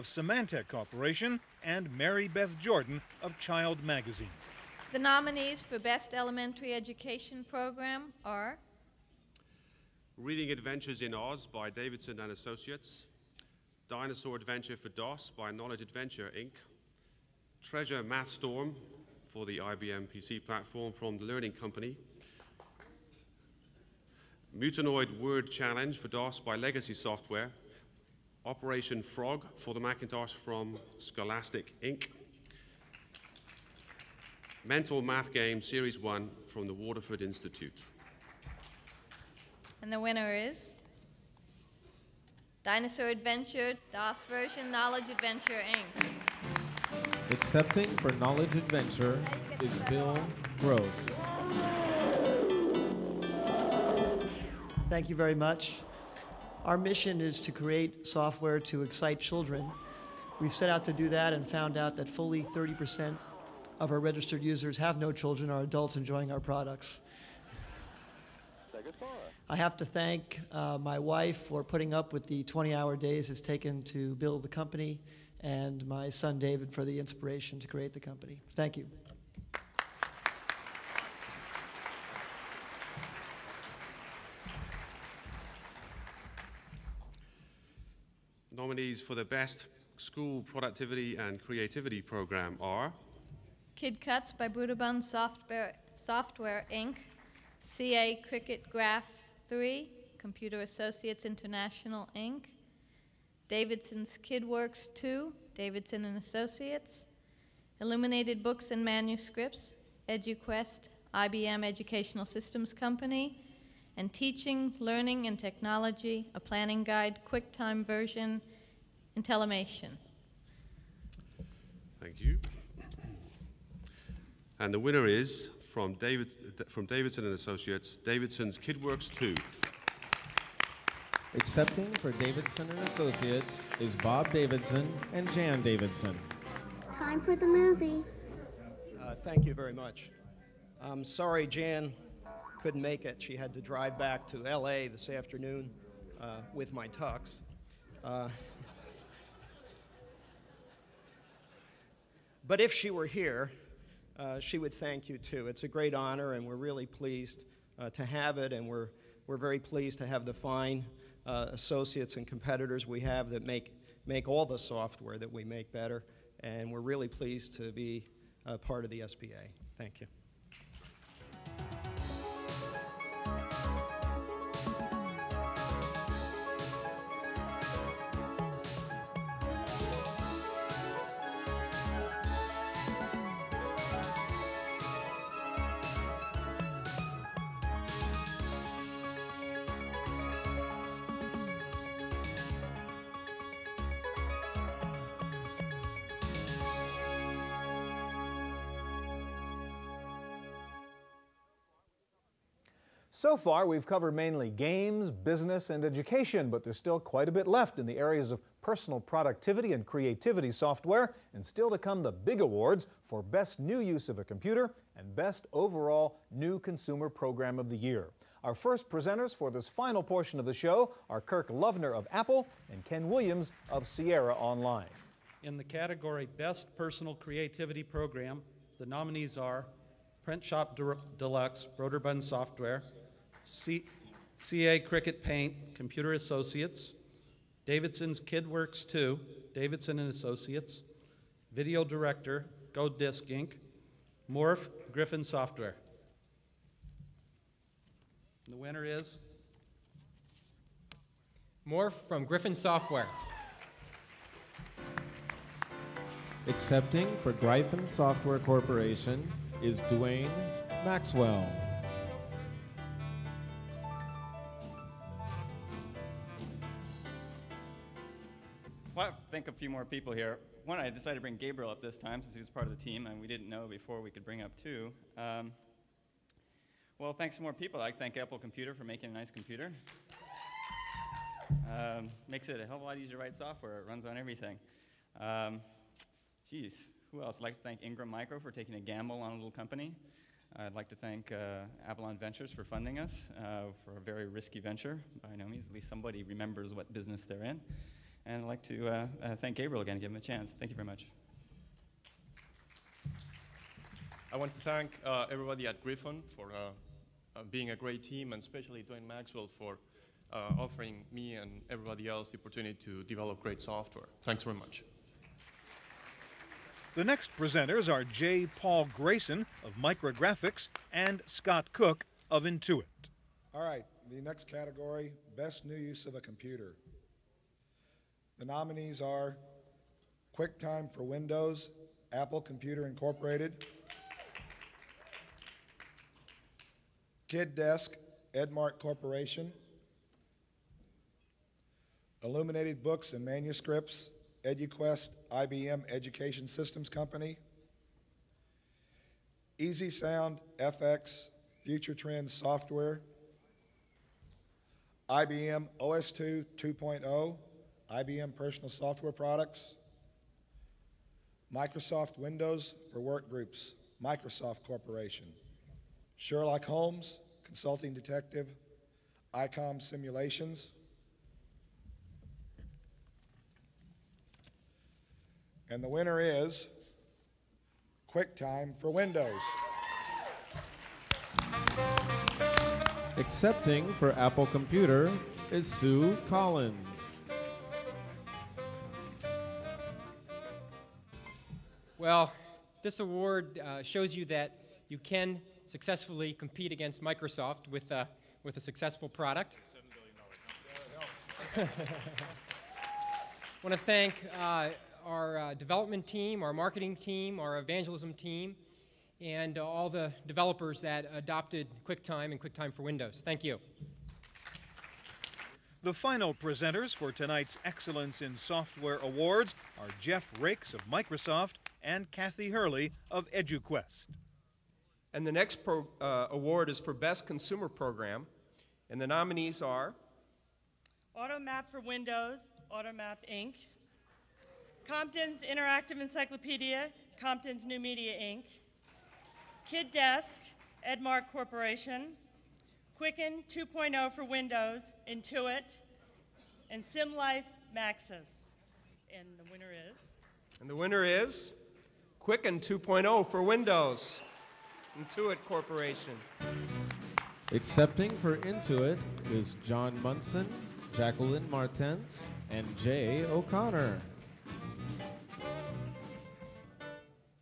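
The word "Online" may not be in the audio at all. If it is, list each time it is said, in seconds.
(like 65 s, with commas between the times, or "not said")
224 s.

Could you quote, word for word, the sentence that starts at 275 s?
Um, well, thanks to more people.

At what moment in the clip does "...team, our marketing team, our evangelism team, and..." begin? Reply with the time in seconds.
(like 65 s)
406 s.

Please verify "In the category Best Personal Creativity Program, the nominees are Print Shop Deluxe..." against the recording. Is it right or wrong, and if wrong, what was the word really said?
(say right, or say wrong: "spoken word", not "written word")
right.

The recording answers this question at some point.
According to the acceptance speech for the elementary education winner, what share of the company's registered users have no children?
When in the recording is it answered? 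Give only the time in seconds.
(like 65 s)
62 s.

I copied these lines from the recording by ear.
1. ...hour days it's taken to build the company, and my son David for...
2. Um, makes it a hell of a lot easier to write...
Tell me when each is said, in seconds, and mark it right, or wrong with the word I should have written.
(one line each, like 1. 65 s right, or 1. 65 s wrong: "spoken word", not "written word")
1. 72 s right
2. 281 s right.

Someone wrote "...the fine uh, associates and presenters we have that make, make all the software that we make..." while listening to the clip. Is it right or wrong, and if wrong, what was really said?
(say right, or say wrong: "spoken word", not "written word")
wrong: "competitors", not "presenters".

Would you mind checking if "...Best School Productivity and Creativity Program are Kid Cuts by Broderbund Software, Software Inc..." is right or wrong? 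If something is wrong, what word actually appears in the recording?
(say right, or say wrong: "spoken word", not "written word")
right.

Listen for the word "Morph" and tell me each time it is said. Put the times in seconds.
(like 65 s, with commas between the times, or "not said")
244 s, 251 s.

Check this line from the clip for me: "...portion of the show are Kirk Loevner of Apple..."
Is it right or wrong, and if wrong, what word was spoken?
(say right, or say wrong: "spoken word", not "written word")
right.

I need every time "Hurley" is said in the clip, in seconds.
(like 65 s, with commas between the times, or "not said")
422 s.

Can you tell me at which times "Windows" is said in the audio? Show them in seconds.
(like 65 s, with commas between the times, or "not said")
331 s, 362 s, 378 s, 412 s, 431 s, 444 s, 453 s.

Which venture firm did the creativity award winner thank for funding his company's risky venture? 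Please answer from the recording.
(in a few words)
Avalon Ventures.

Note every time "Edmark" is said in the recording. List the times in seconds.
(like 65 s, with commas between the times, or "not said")
338 s, 440 s.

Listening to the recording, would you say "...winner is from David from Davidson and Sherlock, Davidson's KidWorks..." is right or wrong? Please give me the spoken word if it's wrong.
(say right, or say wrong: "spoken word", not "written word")
wrong: "Associates", not "Sherlock".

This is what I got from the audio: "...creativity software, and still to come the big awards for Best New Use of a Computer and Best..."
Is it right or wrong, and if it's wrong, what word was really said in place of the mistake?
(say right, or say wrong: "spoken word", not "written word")
right.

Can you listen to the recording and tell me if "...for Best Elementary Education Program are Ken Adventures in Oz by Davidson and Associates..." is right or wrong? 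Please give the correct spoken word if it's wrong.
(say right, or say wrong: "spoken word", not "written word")
wrong: "Reading", not "Ken".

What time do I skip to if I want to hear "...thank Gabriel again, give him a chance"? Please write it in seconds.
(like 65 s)
299 s.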